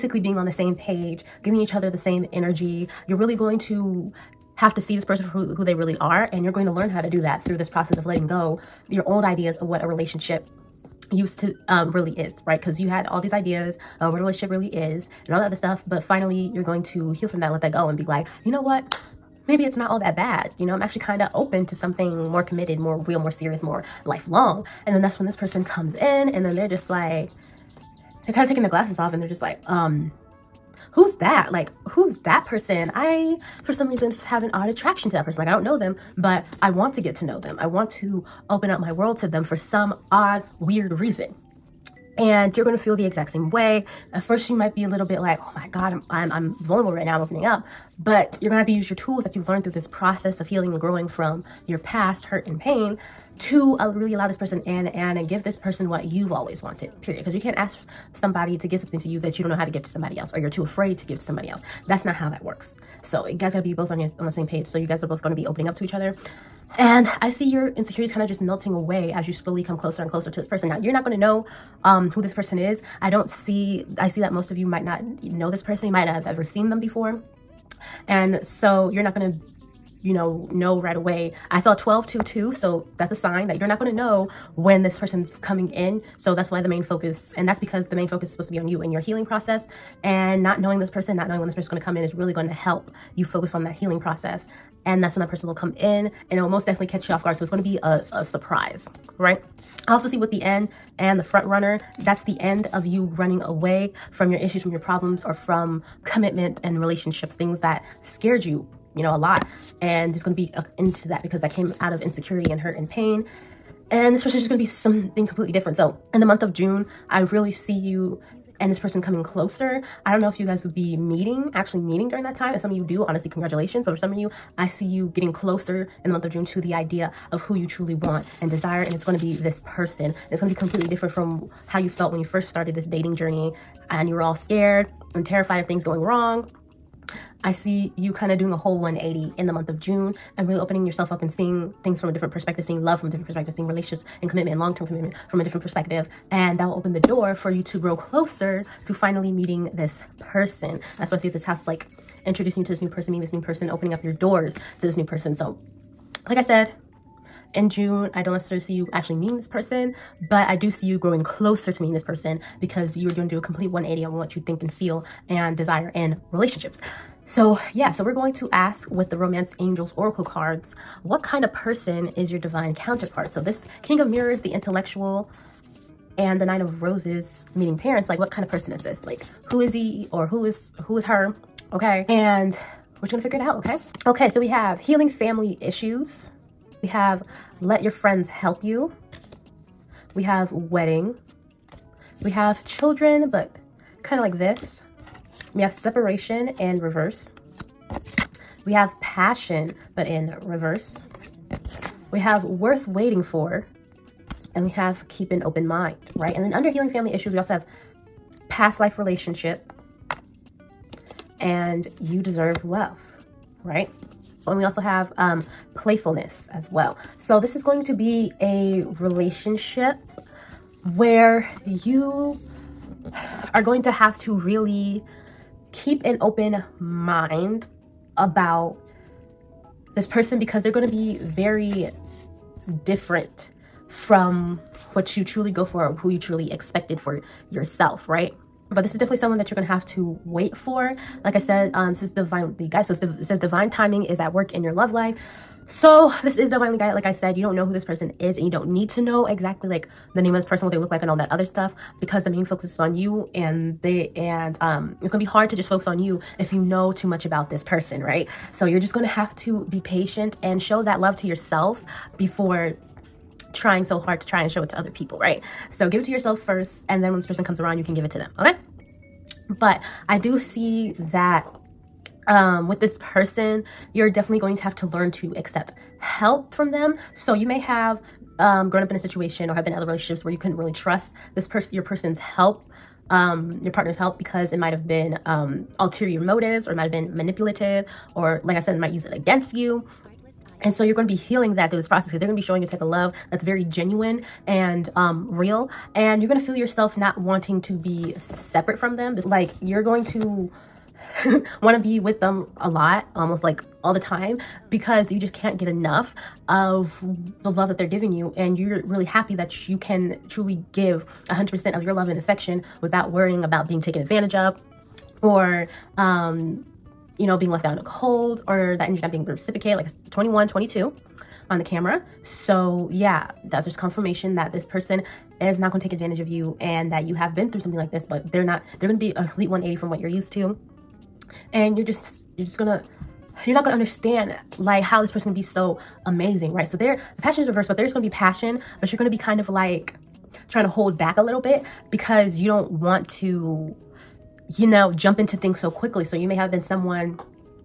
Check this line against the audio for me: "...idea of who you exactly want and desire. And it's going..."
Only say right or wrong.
wrong.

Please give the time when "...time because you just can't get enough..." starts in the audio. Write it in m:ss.
5:03.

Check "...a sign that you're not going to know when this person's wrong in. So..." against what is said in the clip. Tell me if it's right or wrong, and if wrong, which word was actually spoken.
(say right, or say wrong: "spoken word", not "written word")
wrong: "coming", not "wrong".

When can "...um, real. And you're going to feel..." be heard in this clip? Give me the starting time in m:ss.
4:54.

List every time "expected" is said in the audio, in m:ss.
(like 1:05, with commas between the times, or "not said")
3:56.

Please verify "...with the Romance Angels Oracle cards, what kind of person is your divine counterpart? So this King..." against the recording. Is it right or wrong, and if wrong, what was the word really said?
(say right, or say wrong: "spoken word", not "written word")
right.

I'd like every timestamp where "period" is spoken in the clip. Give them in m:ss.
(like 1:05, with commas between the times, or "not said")
0:57.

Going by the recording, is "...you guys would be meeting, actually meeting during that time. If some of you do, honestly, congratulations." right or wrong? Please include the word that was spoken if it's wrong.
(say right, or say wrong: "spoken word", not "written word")
right.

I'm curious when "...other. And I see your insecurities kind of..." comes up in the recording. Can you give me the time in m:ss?
1:05.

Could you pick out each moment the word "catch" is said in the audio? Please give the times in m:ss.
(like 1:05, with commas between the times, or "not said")
1:36.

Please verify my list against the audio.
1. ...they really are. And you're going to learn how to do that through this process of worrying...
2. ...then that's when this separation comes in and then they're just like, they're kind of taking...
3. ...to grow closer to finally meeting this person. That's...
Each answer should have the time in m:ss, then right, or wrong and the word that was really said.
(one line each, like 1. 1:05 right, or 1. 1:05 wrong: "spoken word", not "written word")
1. 0:05 wrong: "letting", not "worrying"
2. 0:24 wrong: "person", not "separation"
3. 2:27 right.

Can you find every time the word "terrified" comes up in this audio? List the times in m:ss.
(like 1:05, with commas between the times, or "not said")
2:15.